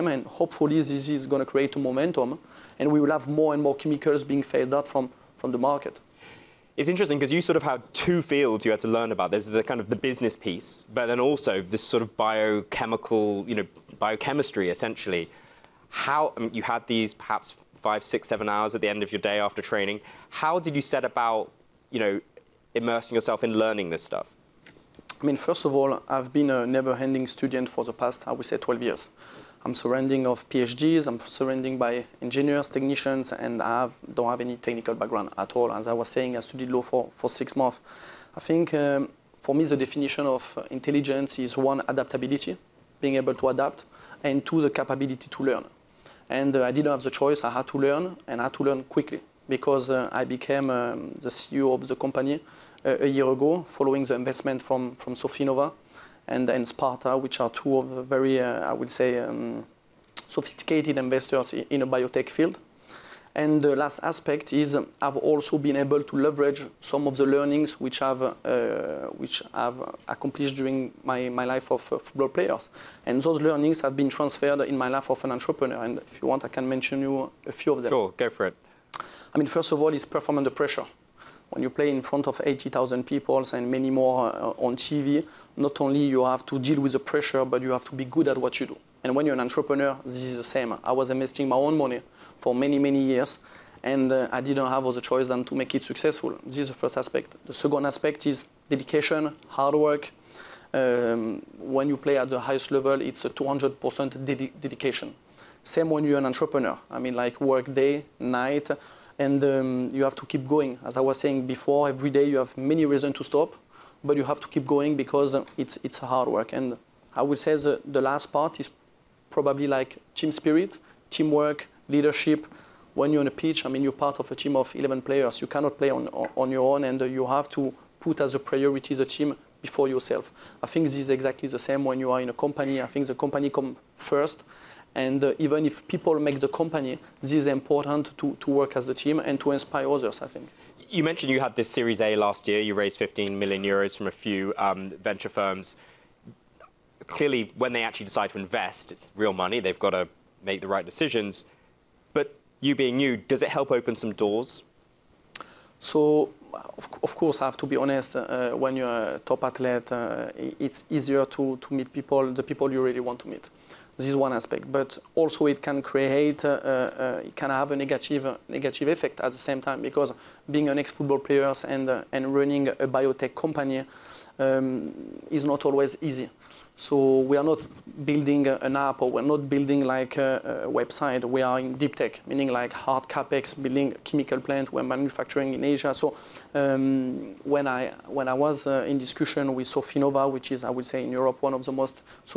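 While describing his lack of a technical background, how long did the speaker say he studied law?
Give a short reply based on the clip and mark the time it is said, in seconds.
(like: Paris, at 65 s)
6 months, at 37 s.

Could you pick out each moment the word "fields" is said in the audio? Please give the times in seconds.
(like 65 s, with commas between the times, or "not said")
8 s, 62 s.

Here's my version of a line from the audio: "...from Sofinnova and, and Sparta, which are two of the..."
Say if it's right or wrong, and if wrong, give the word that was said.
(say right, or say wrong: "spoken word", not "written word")
right.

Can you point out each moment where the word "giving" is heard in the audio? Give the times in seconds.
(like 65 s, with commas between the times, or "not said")
not said.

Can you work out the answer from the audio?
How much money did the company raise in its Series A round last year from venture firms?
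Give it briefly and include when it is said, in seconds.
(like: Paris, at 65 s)
15 million euros, at 142 s.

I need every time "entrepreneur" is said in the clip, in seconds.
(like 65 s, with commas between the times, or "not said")
75 s, 89 s, 106 s.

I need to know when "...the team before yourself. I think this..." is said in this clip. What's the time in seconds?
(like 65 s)
128 s.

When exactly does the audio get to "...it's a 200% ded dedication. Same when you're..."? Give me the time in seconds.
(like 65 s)
102 s.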